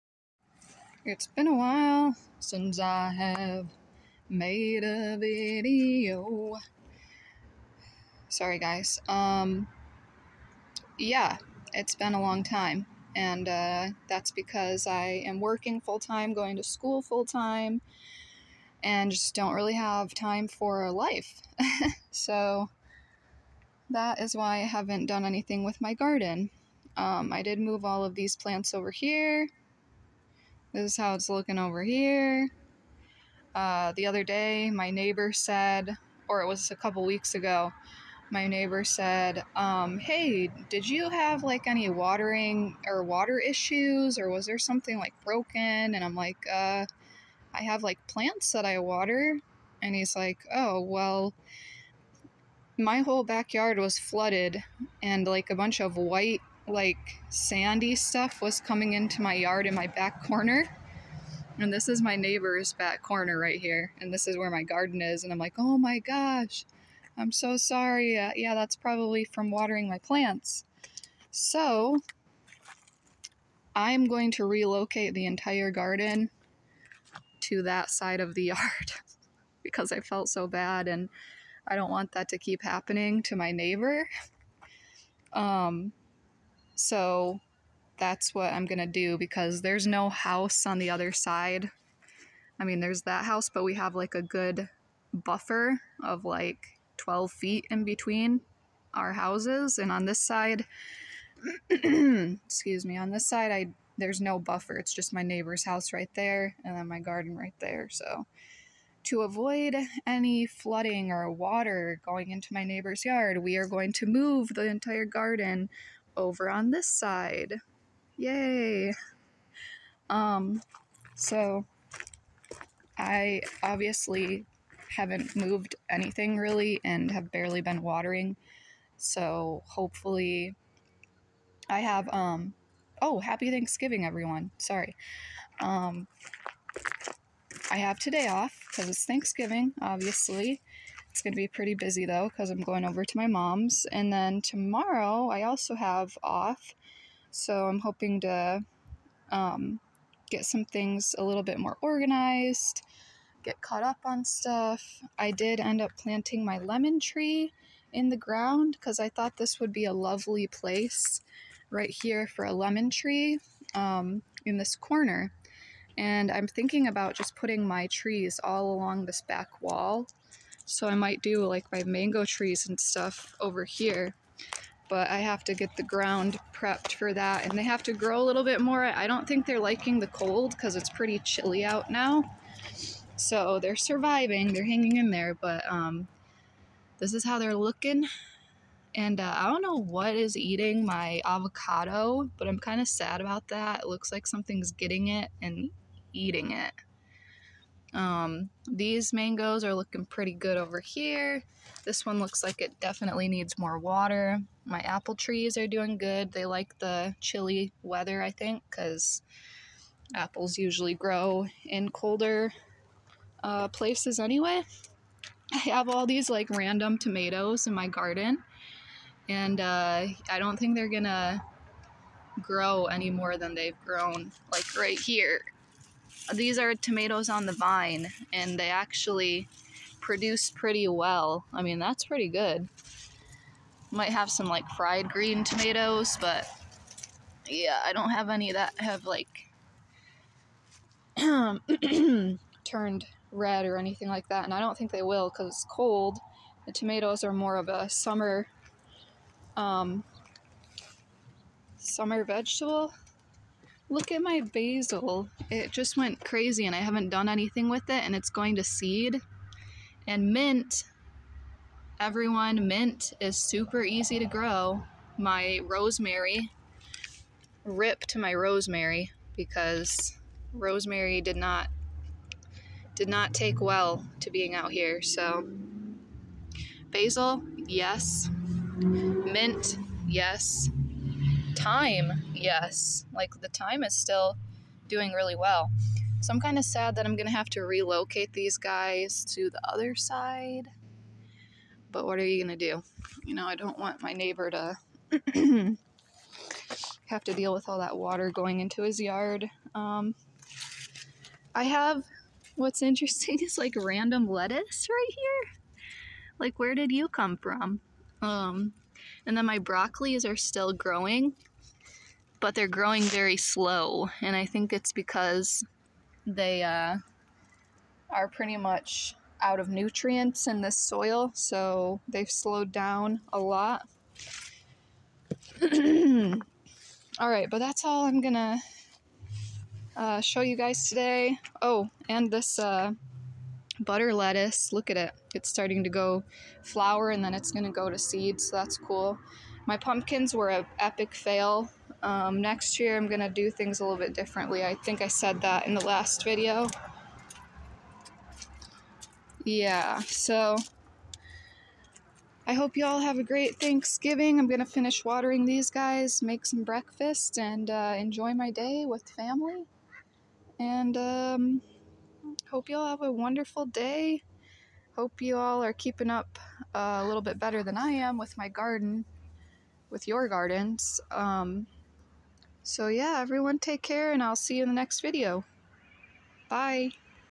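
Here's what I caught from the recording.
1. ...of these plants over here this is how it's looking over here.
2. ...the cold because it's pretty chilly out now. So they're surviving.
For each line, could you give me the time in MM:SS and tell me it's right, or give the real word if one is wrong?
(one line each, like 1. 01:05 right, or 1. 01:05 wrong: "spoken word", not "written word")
1. 00:28 right
2. 02:59 right.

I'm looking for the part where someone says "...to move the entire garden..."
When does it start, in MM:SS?
01:53.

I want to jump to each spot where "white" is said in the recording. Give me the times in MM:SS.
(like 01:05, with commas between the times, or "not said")
00:55.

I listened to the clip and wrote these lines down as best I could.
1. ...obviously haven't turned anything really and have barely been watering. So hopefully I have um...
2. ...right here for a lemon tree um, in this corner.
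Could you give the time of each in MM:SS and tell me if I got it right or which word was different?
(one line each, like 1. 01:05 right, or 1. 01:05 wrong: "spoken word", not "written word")
1. 02:03 wrong: "moved", not "turned"
2. 02:41 right.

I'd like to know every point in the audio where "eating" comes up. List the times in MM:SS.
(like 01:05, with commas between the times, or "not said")
03:10, 03:16.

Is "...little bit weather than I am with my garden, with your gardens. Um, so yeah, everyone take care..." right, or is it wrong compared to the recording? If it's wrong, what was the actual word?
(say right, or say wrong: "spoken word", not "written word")
wrong: "better", not "weather".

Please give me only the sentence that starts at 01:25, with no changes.
Um, so that's what I'm going to do because there's no house on the other side.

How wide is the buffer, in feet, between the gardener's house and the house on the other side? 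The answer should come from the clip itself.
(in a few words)
12 feet.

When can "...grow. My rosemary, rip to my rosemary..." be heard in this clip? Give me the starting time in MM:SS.
04:24.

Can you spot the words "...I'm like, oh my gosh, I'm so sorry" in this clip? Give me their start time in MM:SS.
01:05.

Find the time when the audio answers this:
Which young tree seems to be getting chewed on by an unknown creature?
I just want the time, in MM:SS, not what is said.
03:11.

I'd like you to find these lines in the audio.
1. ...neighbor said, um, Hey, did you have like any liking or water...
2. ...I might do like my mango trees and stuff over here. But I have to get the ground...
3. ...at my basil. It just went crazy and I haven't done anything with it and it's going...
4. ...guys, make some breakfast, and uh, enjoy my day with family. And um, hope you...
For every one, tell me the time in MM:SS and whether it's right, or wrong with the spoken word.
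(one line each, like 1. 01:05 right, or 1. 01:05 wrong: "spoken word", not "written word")
1. 00:38 wrong: "watering", not "liking"
2. 02:50 right
3. 04:14 right
4. 05:55 right.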